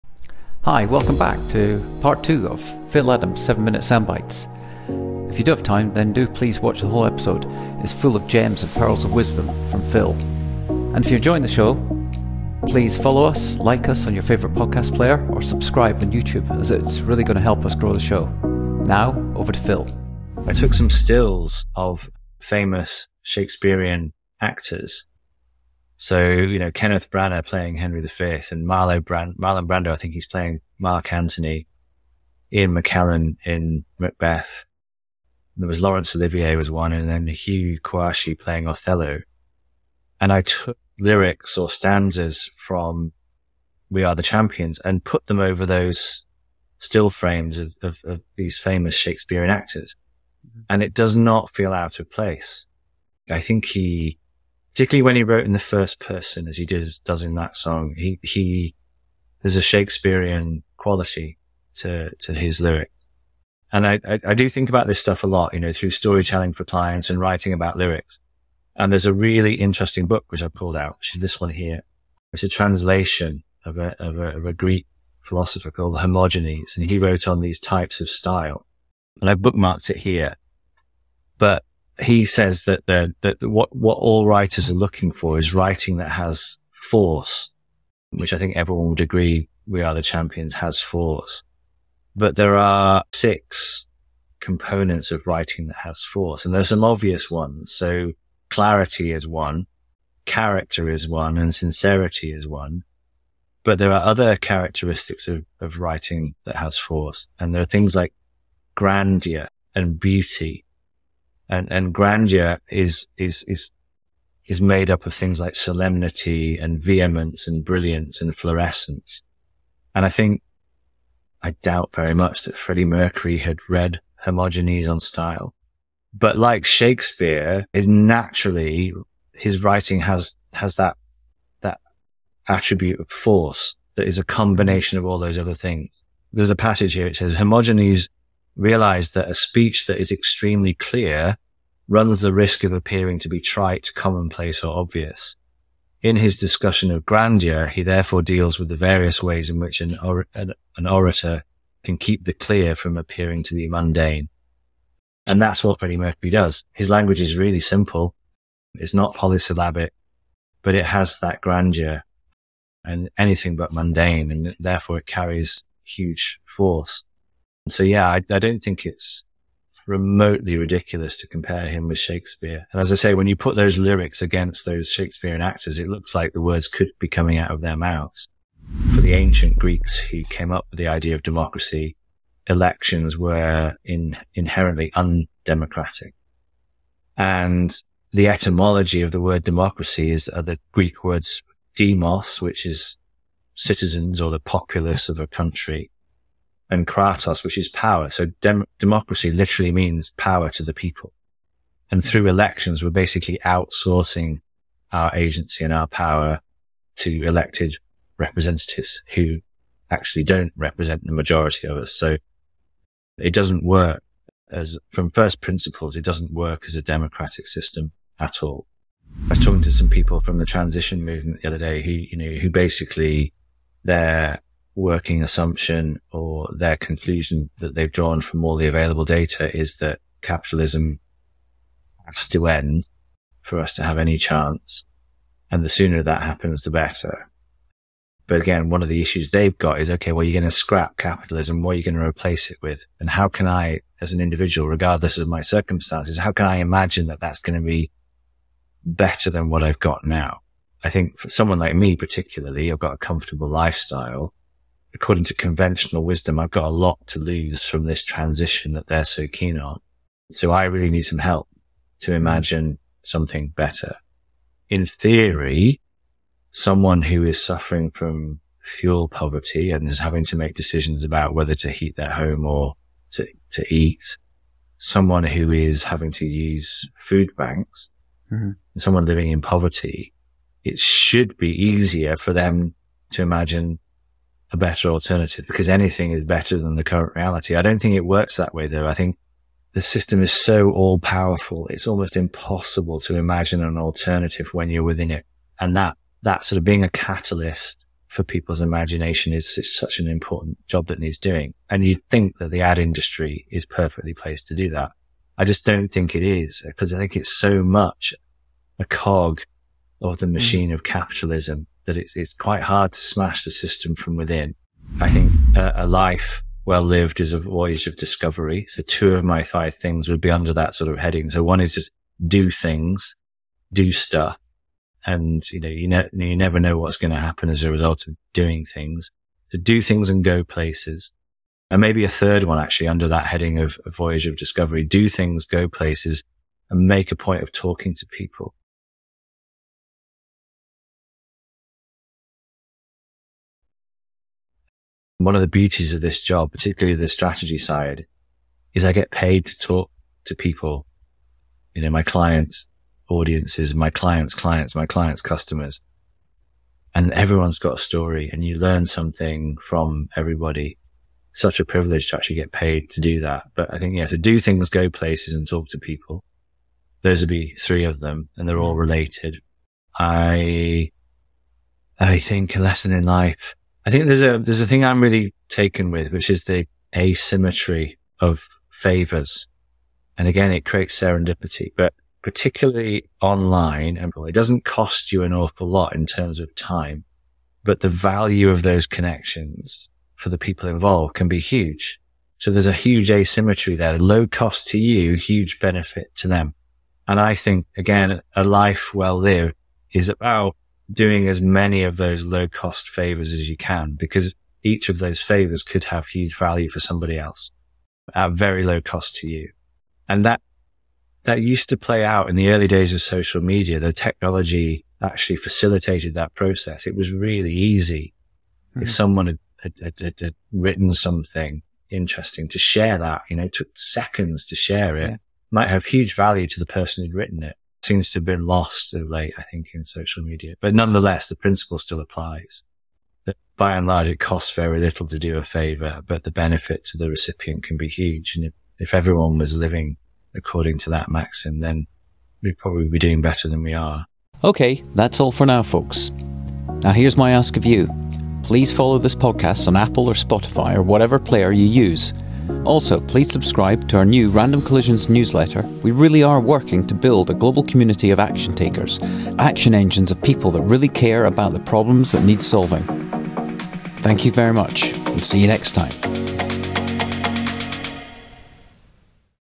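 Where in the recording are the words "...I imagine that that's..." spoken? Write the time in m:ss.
4:06.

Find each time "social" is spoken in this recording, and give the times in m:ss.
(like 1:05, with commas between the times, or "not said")
6:53, 7:09.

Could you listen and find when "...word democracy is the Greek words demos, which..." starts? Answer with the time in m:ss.
3:09.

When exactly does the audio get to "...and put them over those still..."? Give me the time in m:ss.
0:44.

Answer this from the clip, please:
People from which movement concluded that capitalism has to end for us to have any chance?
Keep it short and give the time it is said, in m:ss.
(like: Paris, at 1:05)
transition movement, at 3:40.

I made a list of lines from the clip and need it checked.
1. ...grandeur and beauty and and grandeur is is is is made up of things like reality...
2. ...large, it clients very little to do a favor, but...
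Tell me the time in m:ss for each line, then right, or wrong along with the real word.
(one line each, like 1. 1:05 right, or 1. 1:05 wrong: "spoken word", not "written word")
1. 1:48 wrong: "solemnity", not "reality"
2. 7:13 wrong: "costs", not "clients".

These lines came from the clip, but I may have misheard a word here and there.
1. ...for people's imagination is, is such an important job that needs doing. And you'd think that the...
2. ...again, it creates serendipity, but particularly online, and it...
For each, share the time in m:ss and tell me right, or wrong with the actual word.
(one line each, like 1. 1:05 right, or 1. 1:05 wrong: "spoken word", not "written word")
1. 4:58 right
2. 6:20 right.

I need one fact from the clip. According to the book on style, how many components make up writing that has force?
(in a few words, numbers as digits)
6.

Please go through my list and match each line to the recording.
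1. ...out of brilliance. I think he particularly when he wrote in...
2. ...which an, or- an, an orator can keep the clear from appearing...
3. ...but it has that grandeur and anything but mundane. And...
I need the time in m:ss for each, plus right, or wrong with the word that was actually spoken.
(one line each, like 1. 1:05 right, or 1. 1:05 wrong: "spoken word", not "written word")
1. 0:51 wrong: "place", not "brilliance"
2. 2:29 right
3. 2:40 right.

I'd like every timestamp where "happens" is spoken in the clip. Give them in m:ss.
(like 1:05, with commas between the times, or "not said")
3:56, 5:27.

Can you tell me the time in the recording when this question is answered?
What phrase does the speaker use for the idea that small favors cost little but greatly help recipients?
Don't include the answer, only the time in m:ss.
6:16.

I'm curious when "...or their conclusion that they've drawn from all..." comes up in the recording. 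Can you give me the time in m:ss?
3:46.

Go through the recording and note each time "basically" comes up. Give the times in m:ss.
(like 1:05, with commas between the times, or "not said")
3:22, 3:42.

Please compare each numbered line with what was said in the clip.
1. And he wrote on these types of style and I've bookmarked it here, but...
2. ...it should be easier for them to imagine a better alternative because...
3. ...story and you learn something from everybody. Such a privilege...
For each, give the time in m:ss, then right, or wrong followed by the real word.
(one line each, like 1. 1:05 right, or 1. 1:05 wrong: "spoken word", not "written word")
1. 1:16 right
2. 4:40 right
3. 5:57 right.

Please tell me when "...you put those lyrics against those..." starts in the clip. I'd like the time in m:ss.
2:53.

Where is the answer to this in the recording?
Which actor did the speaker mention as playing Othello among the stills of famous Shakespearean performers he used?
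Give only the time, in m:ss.
0:37.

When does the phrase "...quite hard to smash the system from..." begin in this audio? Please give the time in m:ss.
5:12.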